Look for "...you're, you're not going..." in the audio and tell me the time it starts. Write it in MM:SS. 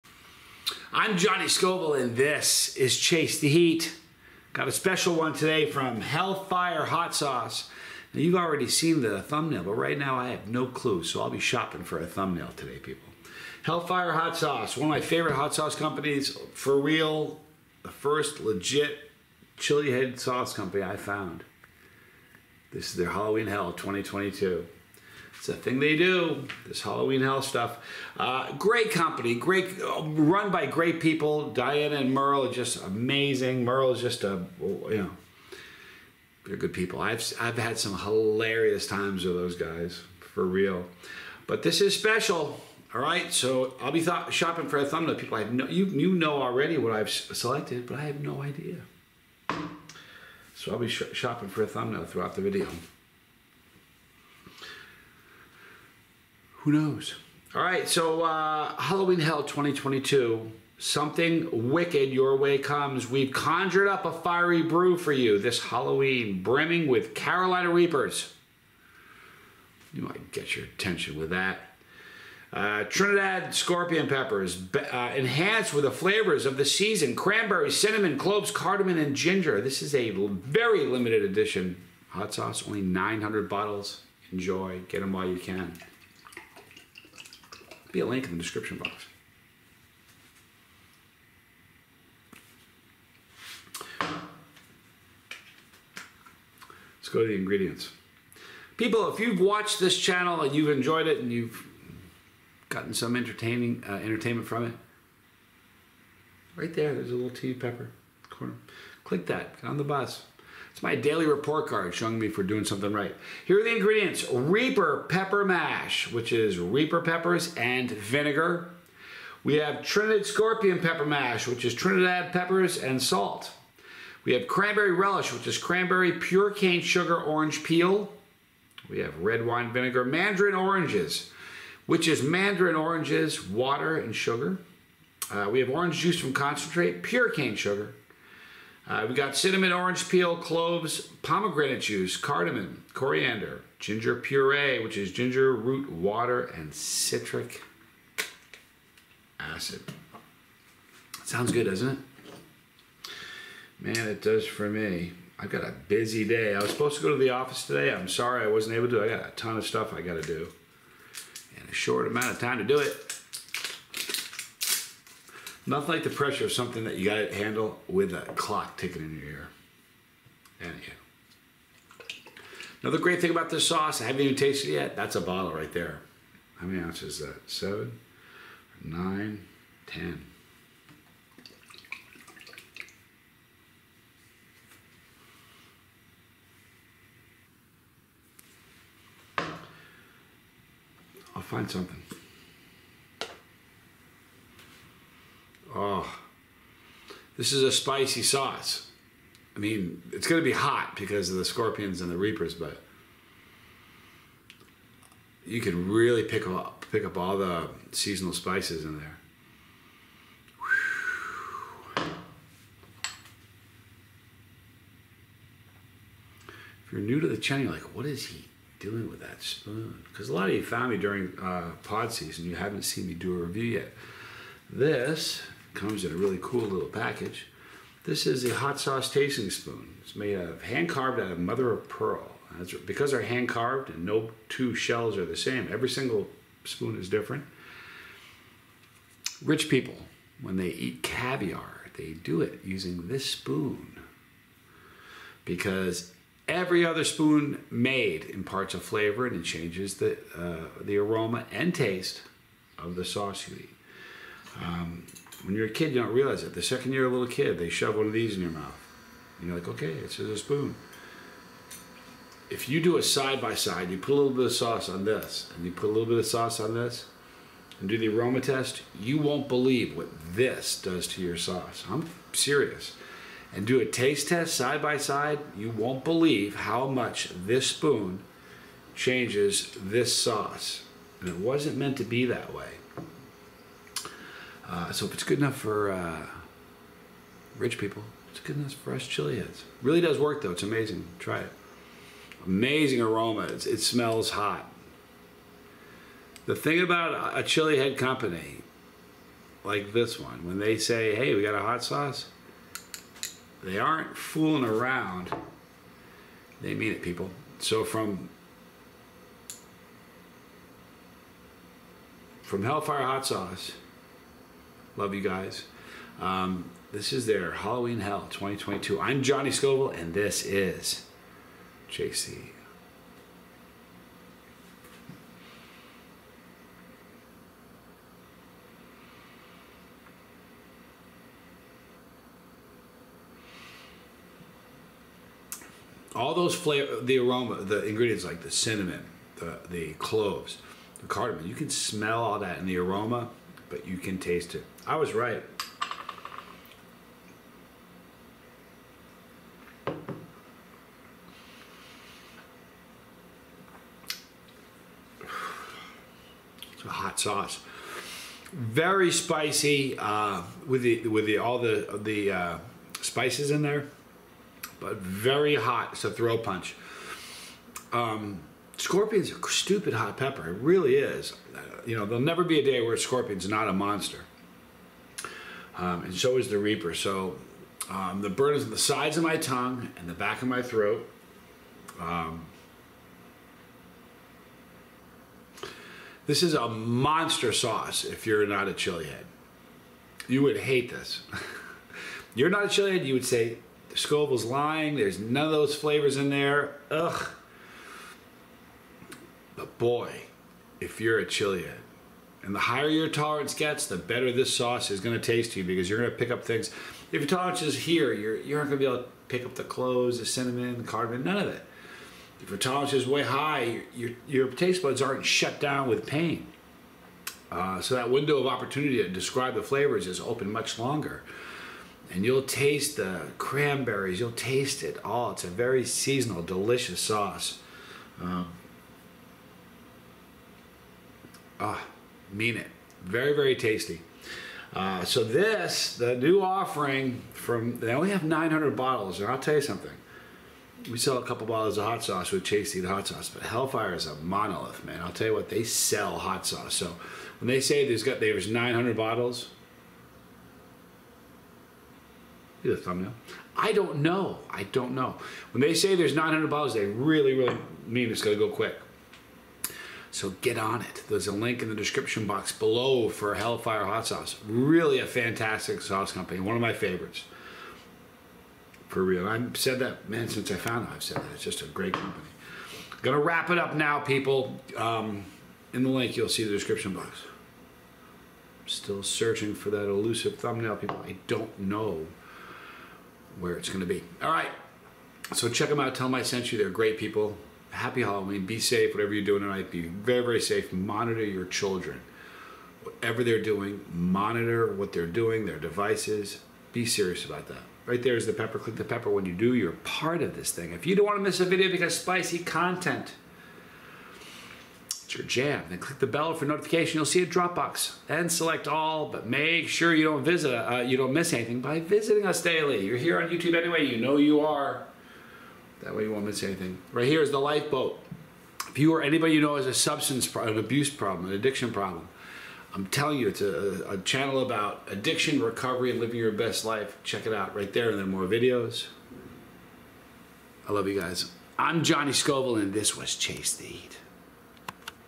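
06:48.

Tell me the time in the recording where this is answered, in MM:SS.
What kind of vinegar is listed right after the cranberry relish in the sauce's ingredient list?
02:09.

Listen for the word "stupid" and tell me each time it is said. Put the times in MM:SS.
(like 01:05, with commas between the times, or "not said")
06:09.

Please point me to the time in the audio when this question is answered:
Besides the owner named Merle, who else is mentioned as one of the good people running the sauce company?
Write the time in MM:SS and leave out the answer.
00:31.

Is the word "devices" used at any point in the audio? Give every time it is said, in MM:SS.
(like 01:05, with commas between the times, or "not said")
08:15.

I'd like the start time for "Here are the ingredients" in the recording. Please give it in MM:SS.
01:53.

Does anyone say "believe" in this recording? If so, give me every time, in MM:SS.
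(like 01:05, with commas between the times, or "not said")
04:29, 04:36.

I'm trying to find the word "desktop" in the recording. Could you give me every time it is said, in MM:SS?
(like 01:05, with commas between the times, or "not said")
not said.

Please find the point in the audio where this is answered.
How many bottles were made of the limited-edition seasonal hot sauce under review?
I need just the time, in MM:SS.
01:22.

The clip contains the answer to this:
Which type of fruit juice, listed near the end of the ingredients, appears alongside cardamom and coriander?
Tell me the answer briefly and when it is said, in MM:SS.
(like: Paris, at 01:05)
Pomegranate juice, at 02:21.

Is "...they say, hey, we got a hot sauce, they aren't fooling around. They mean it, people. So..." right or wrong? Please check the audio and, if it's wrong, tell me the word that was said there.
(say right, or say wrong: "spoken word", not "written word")
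right.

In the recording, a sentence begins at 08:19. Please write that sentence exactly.
When you do, you're part of this thing.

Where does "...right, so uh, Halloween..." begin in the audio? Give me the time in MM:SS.
00:57.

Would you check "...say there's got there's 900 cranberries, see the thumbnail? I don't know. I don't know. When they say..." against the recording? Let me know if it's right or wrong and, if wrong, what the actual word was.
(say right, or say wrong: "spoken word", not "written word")
wrong: "bottles", not "cranberries".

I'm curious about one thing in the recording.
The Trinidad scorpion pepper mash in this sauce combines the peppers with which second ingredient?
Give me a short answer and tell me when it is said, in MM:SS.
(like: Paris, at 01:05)
Salt, at 02:03.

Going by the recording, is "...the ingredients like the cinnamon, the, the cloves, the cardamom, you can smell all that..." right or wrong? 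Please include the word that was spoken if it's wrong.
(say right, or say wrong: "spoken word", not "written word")
right.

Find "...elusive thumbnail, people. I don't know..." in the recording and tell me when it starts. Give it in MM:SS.
07:59.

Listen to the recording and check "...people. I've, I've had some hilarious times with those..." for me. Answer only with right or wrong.
right.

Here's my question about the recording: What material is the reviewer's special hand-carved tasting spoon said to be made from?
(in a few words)
Mother of pearl.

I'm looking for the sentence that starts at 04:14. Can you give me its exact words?
Um, when you're a kid, you don't realize it.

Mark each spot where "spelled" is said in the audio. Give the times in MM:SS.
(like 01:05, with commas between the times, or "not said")
not said.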